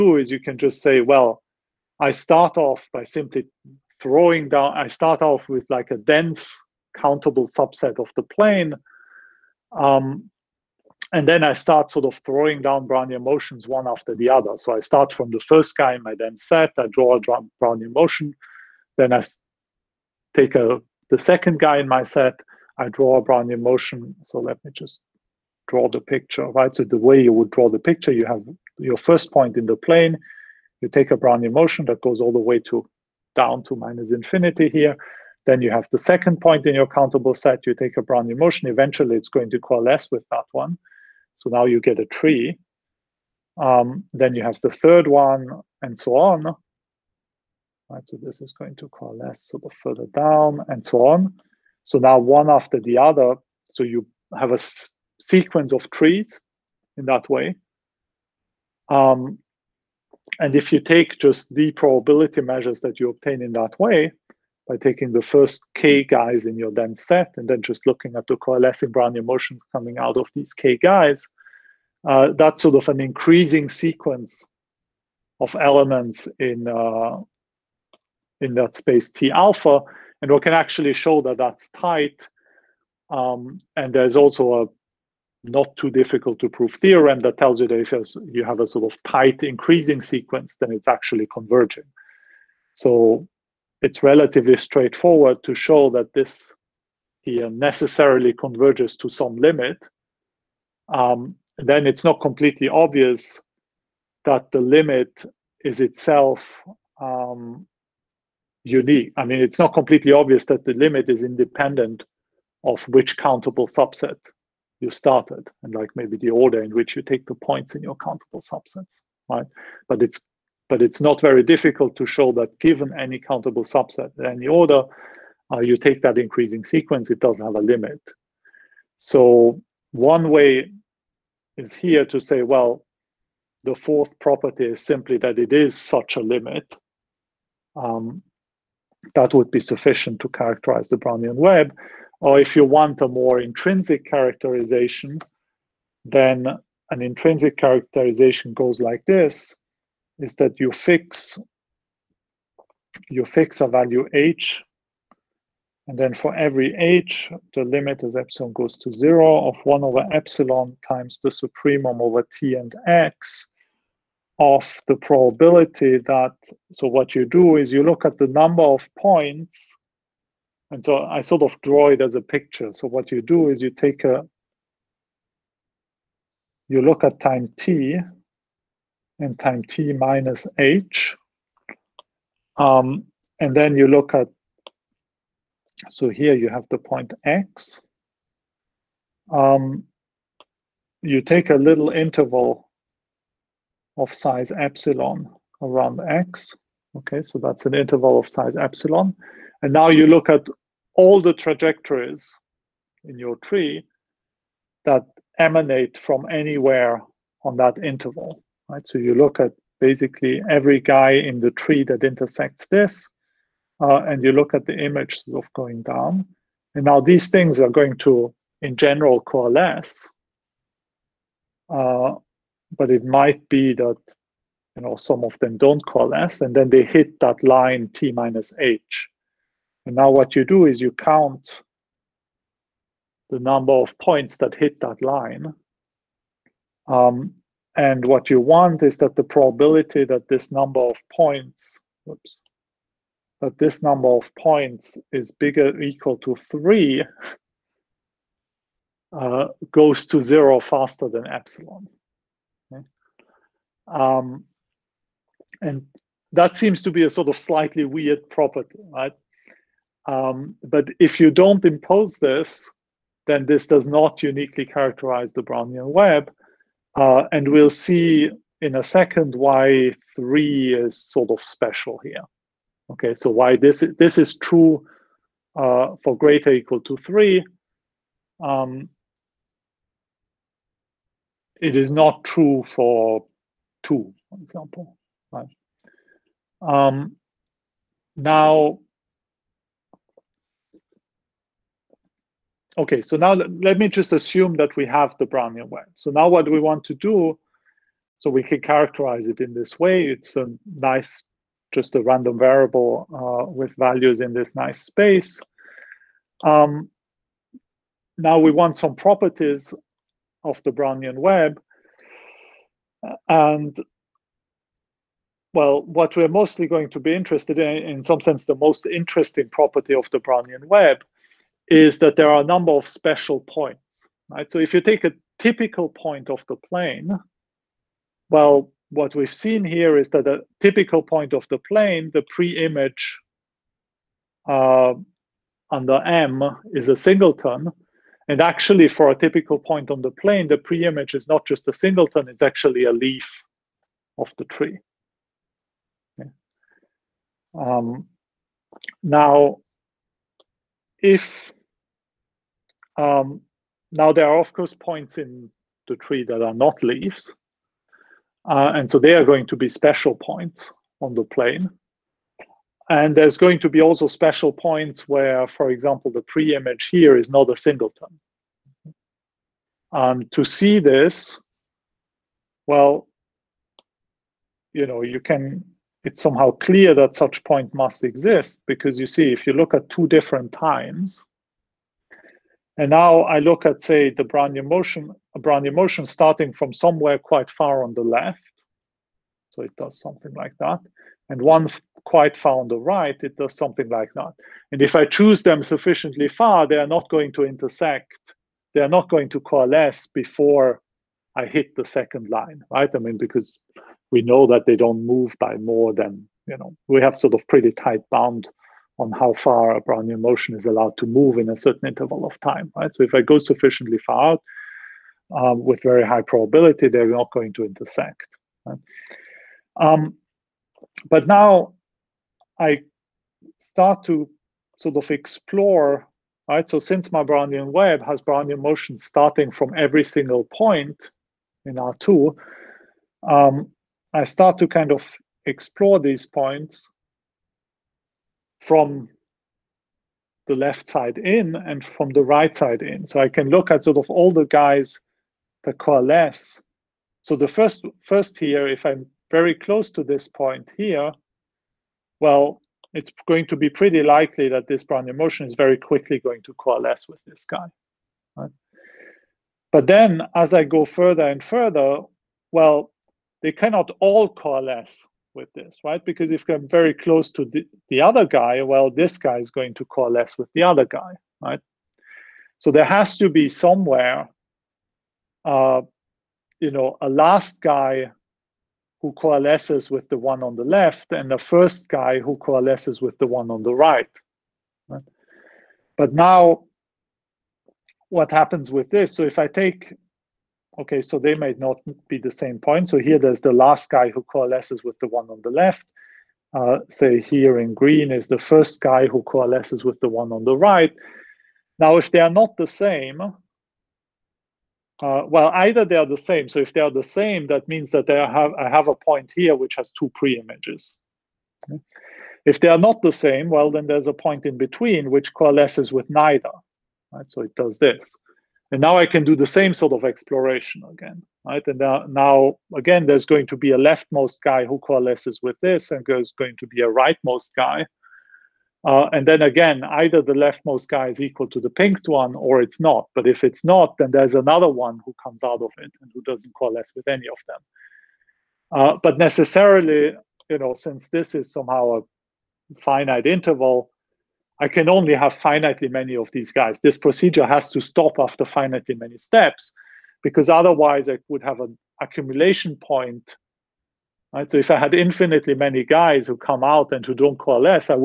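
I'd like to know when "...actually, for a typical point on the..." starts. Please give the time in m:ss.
5:38.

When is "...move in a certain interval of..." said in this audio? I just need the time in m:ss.
6:51.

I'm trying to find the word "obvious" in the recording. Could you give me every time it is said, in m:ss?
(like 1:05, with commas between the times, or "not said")
1:42, 1:50.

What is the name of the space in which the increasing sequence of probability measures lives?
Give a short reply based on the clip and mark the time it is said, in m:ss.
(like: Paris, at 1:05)
T alpha, at 1:19.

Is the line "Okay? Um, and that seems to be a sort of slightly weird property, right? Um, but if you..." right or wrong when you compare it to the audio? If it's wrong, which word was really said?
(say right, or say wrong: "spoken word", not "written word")
right.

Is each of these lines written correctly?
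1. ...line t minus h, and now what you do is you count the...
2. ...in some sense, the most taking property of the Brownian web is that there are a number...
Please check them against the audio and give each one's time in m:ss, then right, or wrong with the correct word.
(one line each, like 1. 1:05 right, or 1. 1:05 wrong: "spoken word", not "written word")
1. 3:47 right
2. 5:17 wrong: "interesting", not "taking".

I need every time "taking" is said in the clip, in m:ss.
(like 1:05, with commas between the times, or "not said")
1:04.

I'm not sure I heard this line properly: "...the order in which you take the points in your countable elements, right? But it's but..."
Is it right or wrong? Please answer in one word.
wrong.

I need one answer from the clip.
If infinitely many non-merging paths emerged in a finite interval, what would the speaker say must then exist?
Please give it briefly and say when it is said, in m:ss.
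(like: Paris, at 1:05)
an accumulation point, at 9:11.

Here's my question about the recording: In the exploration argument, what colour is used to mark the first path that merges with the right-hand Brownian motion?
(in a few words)
green.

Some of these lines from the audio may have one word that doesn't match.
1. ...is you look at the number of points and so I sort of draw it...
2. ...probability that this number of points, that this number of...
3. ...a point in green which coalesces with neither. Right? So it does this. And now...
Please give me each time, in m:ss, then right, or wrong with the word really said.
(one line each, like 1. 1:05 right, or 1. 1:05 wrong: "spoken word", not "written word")
1. 2:47 right
2. 3:59 right
3. 8:34 wrong: "between", not "green".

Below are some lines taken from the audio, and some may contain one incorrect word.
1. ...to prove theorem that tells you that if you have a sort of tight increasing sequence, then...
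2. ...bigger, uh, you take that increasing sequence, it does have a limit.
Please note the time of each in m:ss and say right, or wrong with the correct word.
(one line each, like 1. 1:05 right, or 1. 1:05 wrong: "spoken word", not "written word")
1. 1:26 right
2. 2:04 wrong: "order", not "bigger".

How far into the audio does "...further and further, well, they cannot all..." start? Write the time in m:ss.
7:40.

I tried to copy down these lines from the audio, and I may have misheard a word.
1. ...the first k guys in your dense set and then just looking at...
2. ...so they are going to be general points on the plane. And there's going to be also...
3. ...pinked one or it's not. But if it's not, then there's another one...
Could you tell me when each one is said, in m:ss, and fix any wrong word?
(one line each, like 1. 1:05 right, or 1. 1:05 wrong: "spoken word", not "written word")
1. 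1:05 right
2. 5:58 wrong: "special", not "general"
3. 8:51 right.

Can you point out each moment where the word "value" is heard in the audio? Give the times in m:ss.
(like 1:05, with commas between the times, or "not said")
2:33, 5:03.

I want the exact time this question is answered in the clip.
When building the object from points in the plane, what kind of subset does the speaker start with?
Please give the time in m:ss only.
0:05.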